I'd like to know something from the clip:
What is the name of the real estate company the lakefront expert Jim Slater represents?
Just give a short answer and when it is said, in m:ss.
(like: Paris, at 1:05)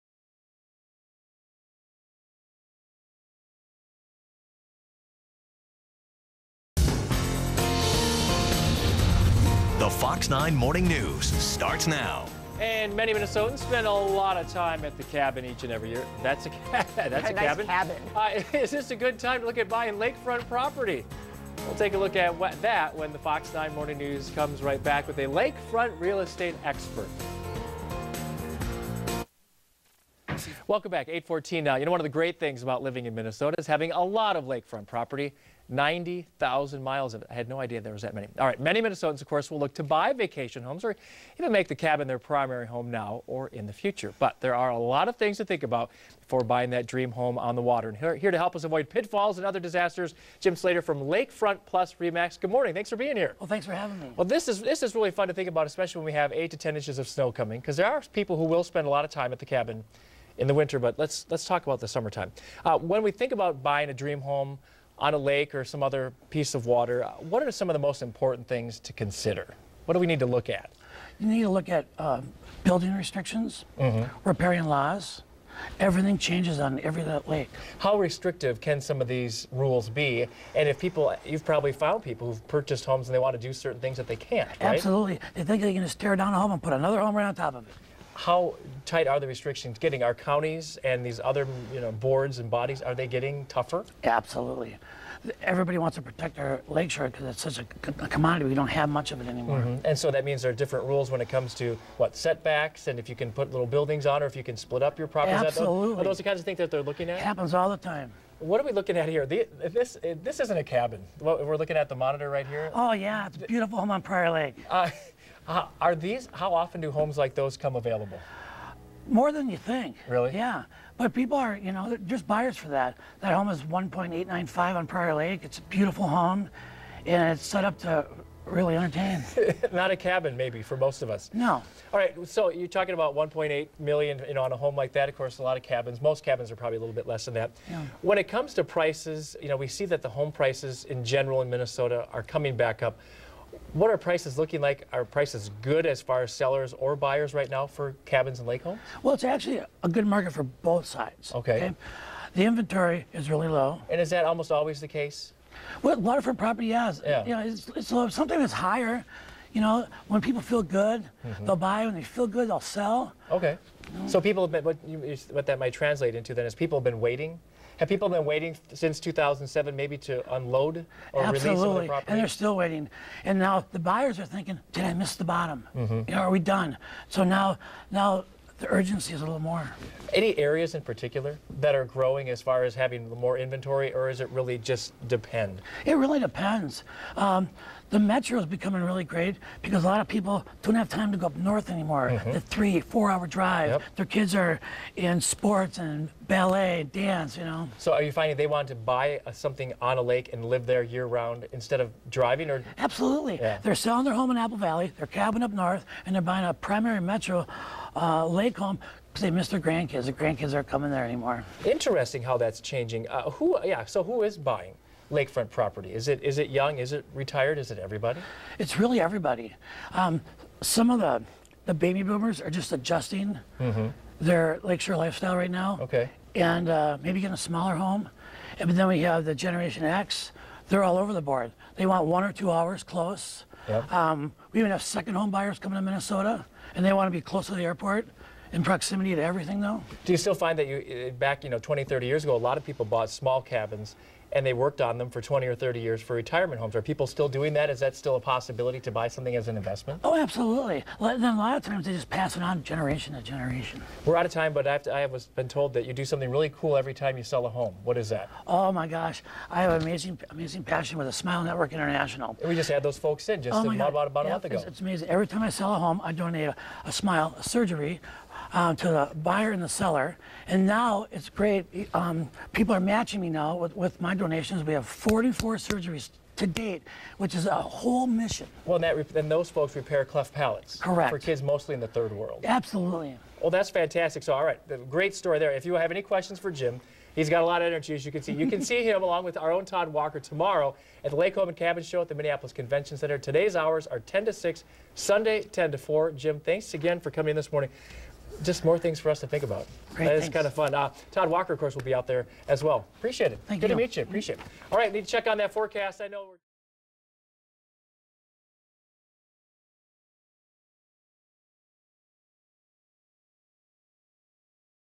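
Lakefront Plus Remax, at 0:51.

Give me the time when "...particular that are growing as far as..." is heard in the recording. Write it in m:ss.
3:00.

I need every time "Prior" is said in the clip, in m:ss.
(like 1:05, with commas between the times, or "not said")
1:54, 2:04.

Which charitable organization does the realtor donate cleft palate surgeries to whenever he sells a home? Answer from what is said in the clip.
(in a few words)
Smile Network International.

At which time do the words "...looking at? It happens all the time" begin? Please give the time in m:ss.
1:46.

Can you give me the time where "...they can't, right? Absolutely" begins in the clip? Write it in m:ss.
1:24.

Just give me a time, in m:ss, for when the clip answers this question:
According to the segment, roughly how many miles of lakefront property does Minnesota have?
0:35.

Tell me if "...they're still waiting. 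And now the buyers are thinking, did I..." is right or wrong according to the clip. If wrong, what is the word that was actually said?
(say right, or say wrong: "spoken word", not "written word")
right.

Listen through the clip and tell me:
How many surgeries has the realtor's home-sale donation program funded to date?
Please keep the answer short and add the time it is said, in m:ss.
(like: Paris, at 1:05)
44, at 4:34.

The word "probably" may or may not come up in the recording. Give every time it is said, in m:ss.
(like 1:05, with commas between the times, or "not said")
1:21, 2:16.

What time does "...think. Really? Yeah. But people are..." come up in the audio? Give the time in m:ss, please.
1:59.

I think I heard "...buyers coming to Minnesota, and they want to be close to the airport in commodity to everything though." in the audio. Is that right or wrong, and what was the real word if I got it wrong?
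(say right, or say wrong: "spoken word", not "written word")
wrong: "proximity", not "commodity".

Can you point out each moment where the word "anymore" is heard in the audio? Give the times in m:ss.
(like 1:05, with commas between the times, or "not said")
1:39, 3:11, 3:31.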